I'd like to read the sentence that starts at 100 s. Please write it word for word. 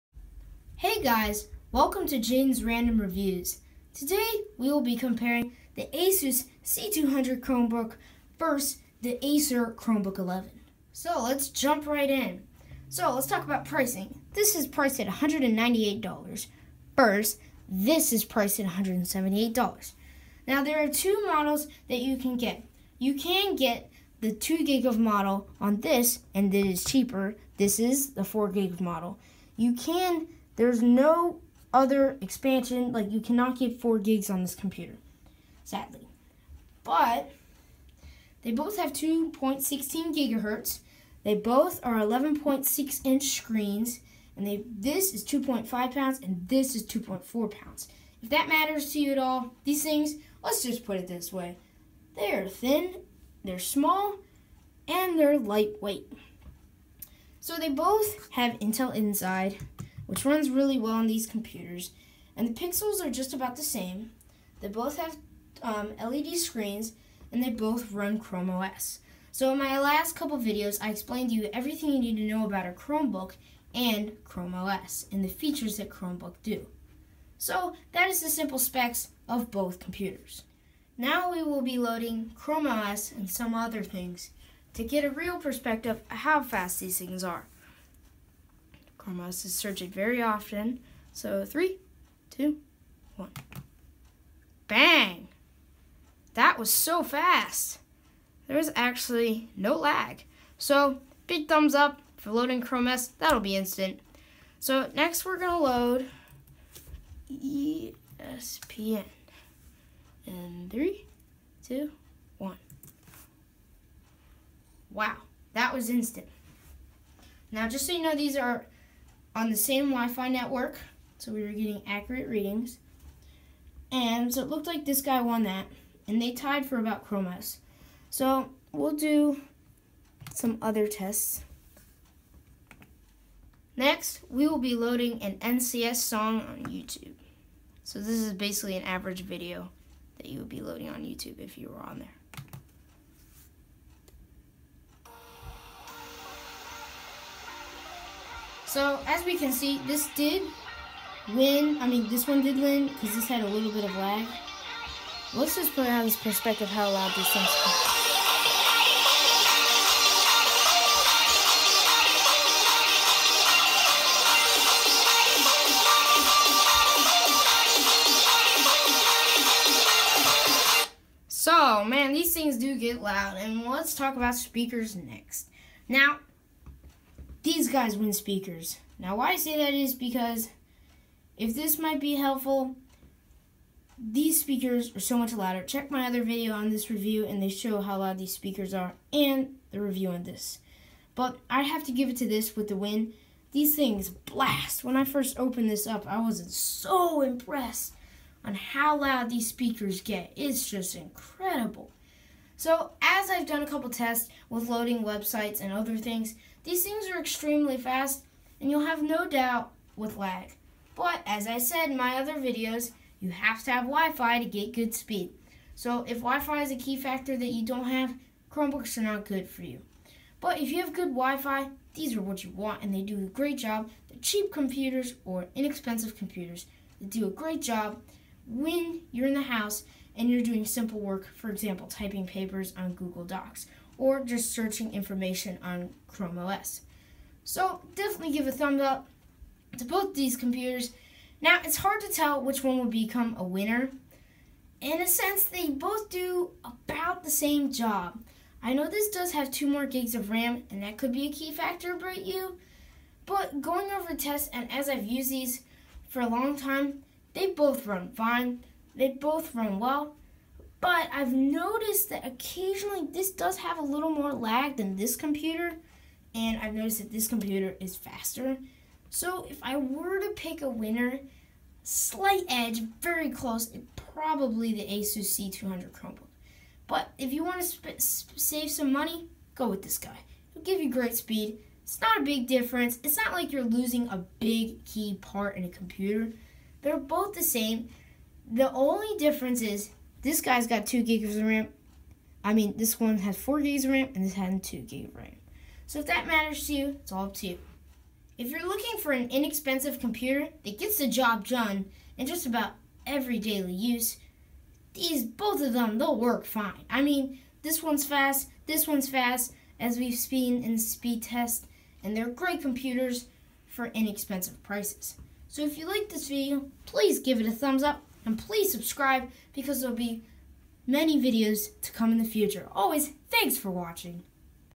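So big thumbs up for loading Chrome OS.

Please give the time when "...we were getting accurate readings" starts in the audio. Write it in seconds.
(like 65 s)
121 s.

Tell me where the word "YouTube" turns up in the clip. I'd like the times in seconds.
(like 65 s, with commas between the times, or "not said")
136 s, 141 s.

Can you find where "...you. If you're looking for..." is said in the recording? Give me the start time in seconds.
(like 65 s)
297 s.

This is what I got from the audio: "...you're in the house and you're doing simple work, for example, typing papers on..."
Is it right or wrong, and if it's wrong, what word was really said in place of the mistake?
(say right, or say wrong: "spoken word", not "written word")
right.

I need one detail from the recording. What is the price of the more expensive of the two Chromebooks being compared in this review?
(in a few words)
$198.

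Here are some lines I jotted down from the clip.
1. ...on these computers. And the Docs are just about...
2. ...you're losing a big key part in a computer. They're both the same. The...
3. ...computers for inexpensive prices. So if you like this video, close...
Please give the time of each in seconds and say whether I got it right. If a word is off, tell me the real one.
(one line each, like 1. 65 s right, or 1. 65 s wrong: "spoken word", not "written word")
1. 60 s wrong: "Pixels", not "Docs"
2. 283 s right
3. 312 s wrong: "please", not "close".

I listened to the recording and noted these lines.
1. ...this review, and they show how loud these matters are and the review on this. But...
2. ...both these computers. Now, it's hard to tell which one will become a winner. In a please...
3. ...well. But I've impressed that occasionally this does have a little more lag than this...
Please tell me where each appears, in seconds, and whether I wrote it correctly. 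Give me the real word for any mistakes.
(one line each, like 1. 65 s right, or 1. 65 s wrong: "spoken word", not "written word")
1. 186 s wrong: "speakers", not "matters"
2. 239 s wrong: "sense", not "please"
3. 259 s wrong: "noticed", not "impressed".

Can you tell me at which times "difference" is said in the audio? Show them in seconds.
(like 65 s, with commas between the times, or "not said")
282 s, 289 s.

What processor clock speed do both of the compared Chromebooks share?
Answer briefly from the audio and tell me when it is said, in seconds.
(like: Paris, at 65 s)
2.16 gigahertz, at 38 s.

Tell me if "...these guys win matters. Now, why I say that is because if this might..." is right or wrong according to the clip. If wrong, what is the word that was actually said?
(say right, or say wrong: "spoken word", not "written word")
wrong: "speakers", not "matters".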